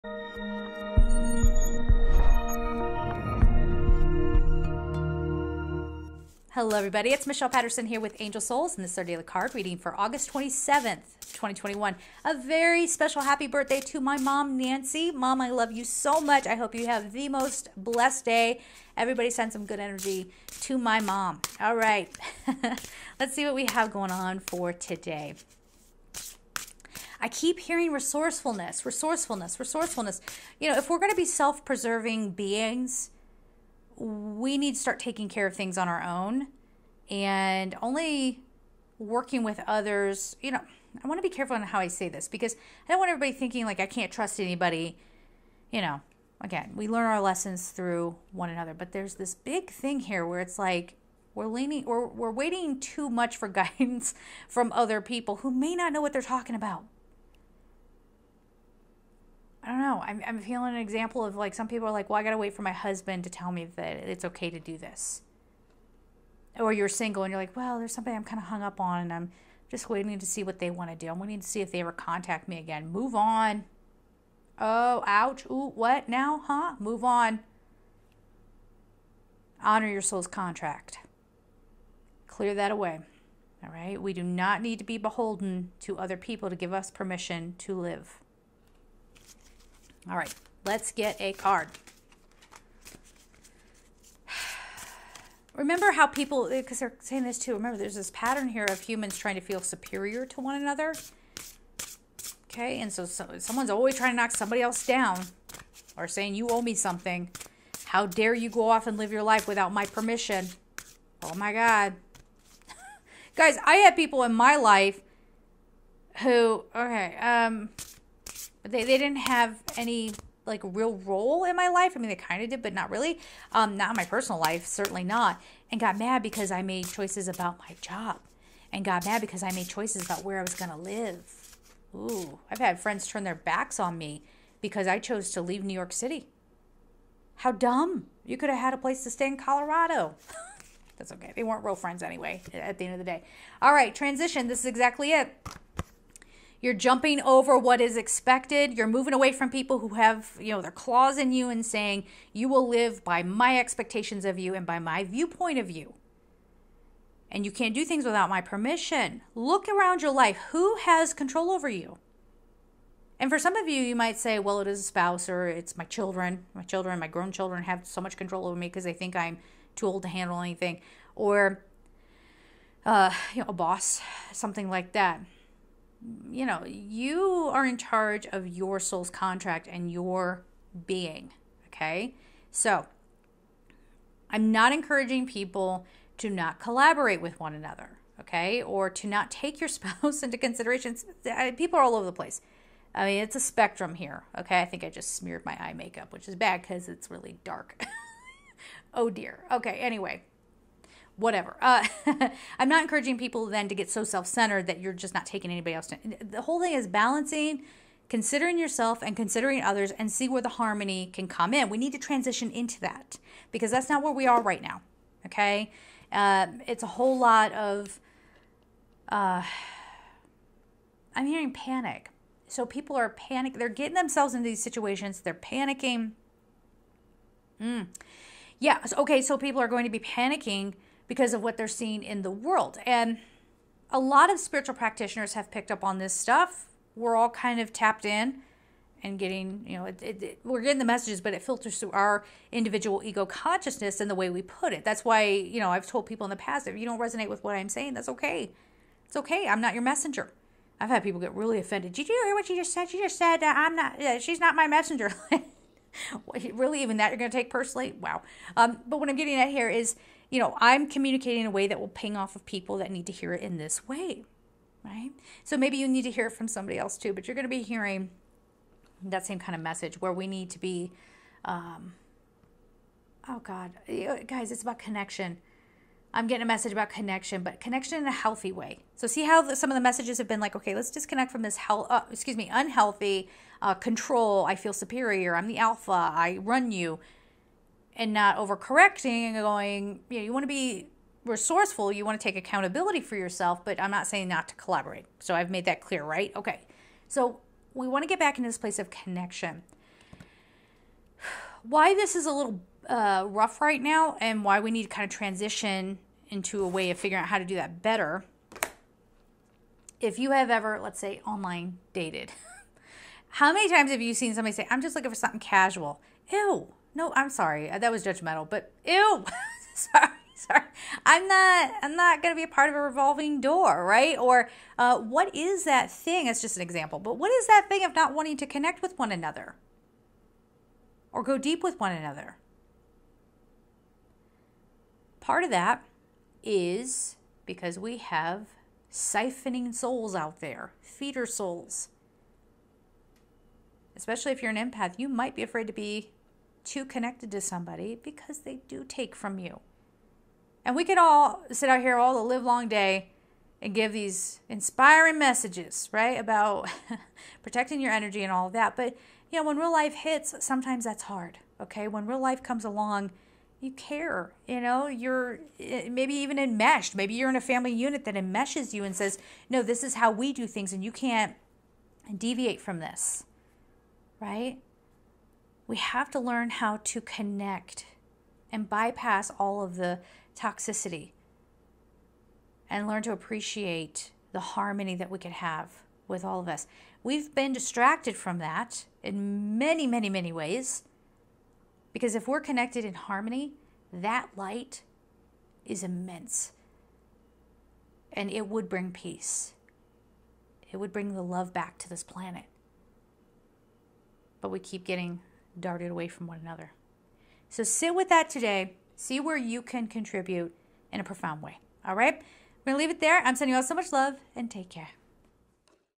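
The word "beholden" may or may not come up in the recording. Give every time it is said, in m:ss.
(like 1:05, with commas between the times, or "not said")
1:24.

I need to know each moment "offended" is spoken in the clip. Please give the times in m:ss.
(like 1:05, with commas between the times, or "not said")
4:11.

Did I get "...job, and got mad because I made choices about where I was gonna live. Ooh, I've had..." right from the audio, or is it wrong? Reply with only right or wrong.
right.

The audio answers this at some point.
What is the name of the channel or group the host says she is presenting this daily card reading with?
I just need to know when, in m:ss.
0:08.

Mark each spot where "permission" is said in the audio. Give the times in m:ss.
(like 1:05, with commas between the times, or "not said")
1:26, 1:49, 2:38.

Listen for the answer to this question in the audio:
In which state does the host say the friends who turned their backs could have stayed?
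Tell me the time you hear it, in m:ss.
2:19.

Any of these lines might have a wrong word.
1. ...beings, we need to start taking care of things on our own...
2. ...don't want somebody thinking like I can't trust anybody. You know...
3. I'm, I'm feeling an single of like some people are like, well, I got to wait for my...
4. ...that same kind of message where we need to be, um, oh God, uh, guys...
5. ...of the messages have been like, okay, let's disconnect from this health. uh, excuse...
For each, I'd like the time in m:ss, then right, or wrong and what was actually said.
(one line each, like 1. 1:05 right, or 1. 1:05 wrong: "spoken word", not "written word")
1. 0:32 right
2. 0:42 wrong: "everybody", not "somebody"
3. 1:00 wrong: "example", not "single"
4. 4:29 right
5. 4:39 right.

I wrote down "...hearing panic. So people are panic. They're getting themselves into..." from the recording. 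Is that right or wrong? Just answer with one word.
right.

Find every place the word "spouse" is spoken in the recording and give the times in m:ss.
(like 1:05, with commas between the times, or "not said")
2:44, 3:09.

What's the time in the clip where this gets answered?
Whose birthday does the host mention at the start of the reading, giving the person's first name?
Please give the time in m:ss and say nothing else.
0:14.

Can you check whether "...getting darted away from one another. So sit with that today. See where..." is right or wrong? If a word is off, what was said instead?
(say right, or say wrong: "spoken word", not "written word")
right.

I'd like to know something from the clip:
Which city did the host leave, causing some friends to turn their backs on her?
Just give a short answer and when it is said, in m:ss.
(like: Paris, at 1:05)
New York City, at 2:15.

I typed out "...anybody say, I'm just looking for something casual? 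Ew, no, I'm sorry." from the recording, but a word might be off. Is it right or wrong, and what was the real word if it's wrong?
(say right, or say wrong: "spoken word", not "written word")
wrong: "somebody", not "anybody".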